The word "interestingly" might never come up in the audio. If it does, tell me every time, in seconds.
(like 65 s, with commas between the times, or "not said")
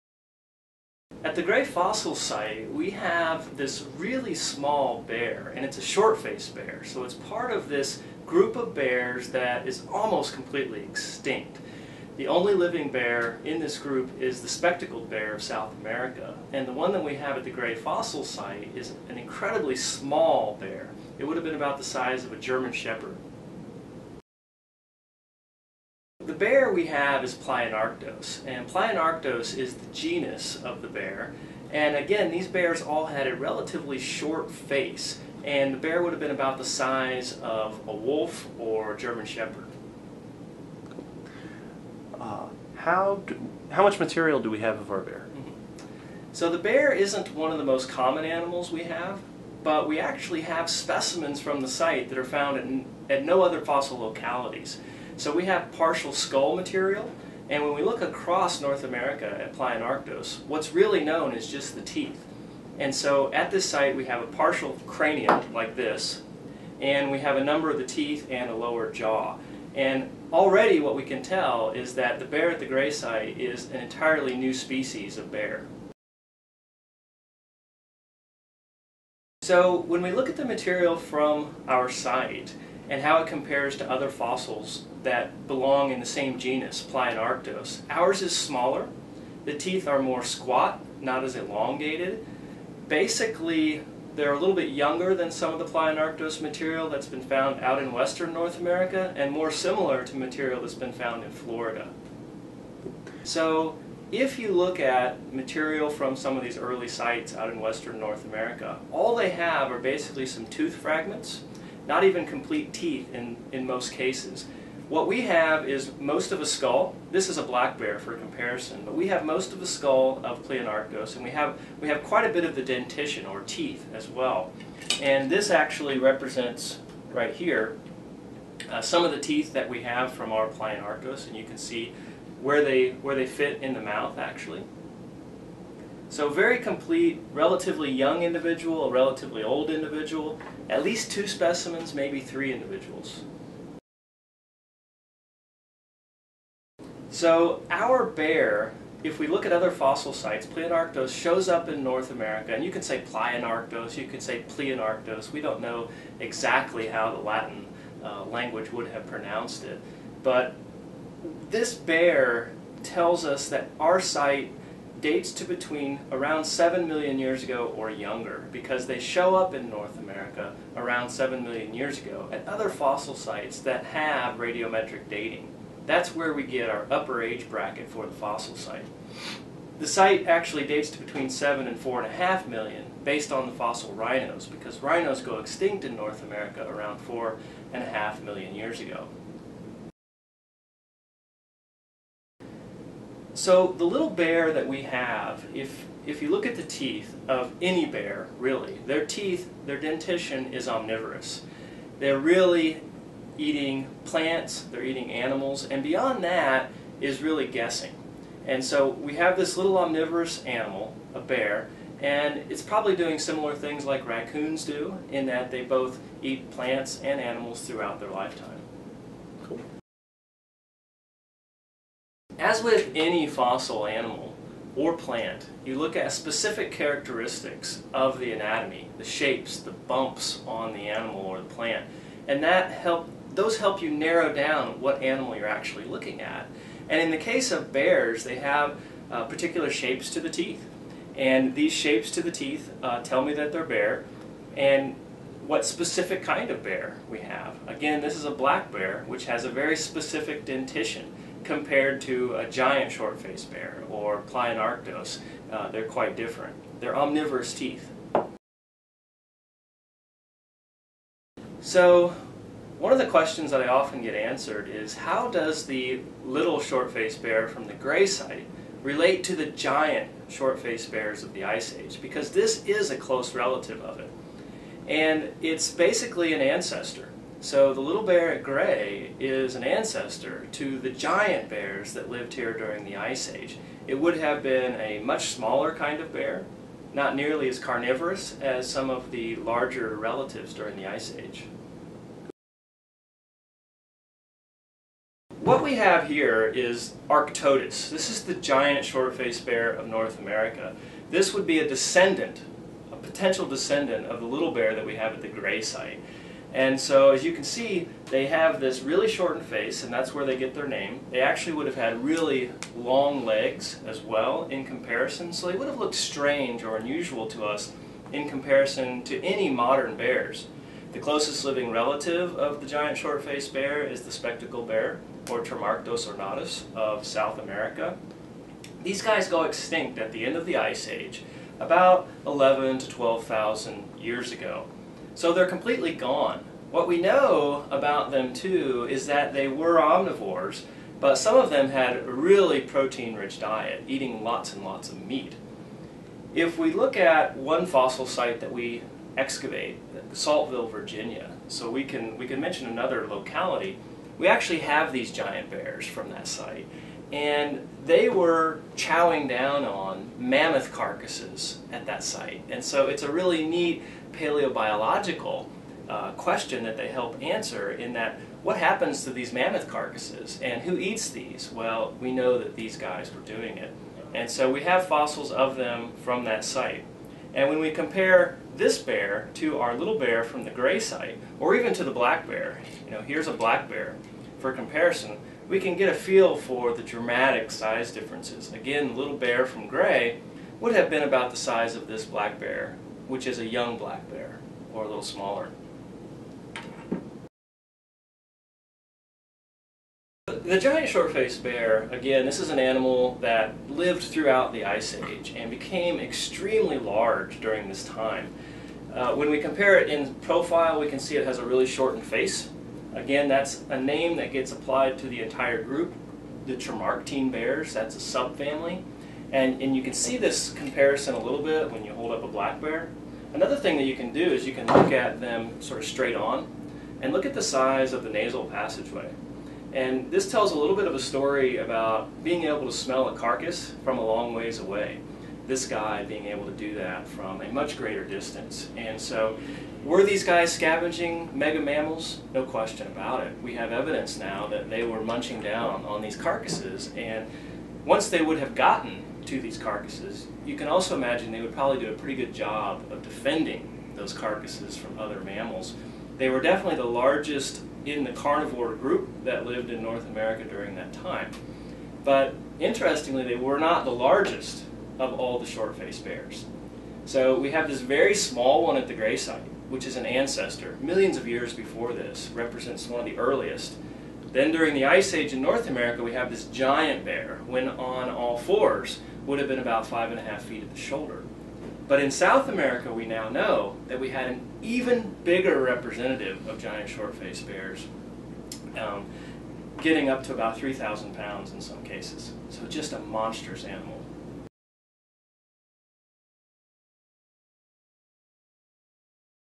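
462 s.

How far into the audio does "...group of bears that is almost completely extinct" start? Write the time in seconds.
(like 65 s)
8 s.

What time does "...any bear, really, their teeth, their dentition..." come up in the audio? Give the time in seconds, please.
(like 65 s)
197 s.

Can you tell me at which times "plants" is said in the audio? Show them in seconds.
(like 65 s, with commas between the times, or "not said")
204 s, 216 s, 224 s, 231 s.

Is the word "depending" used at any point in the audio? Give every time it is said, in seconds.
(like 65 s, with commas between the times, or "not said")
not said.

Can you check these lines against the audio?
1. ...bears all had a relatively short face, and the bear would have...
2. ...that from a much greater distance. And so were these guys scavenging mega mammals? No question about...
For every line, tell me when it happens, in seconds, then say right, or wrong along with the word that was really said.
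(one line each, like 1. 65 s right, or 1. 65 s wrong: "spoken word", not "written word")
1. 32 s right
2. 436 s right.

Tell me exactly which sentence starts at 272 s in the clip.
Because this is a close relative of it.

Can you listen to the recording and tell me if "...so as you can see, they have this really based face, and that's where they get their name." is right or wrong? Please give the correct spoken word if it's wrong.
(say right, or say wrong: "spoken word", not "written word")
wrong: "shortened", not "based".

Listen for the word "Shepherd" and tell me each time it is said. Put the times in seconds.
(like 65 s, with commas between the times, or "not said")
22 s, 39 s.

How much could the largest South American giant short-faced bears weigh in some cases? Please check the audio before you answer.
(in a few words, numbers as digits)
3,000 pounds.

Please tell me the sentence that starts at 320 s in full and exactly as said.
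The closest living relative of the giant short-faced bear is the spectacled bear, or Tremarctos ornatus of South America.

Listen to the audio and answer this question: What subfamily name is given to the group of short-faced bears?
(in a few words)
Tremarctine.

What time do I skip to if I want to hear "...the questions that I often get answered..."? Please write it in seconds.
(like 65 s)
262 s.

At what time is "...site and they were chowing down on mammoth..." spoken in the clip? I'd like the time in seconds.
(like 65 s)
356 s.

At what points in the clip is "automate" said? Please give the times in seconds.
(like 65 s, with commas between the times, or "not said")
not said.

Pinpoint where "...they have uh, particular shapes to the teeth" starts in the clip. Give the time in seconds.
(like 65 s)
238 s.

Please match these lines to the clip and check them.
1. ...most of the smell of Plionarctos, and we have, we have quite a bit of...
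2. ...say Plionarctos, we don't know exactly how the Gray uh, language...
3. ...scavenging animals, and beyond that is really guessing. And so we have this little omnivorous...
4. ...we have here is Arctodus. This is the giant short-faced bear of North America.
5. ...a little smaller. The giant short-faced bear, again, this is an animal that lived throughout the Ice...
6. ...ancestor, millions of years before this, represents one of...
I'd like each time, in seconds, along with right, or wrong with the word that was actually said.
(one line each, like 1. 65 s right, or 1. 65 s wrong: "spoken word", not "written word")
1. 119 s wrong: "skull", not "smell"
2. 154 s wrong: "Latin", not "Gray"
3. 204 s wrong: "eating", not "scavenging"
4. 295 s right
5. 394 s right
6. 470 s right.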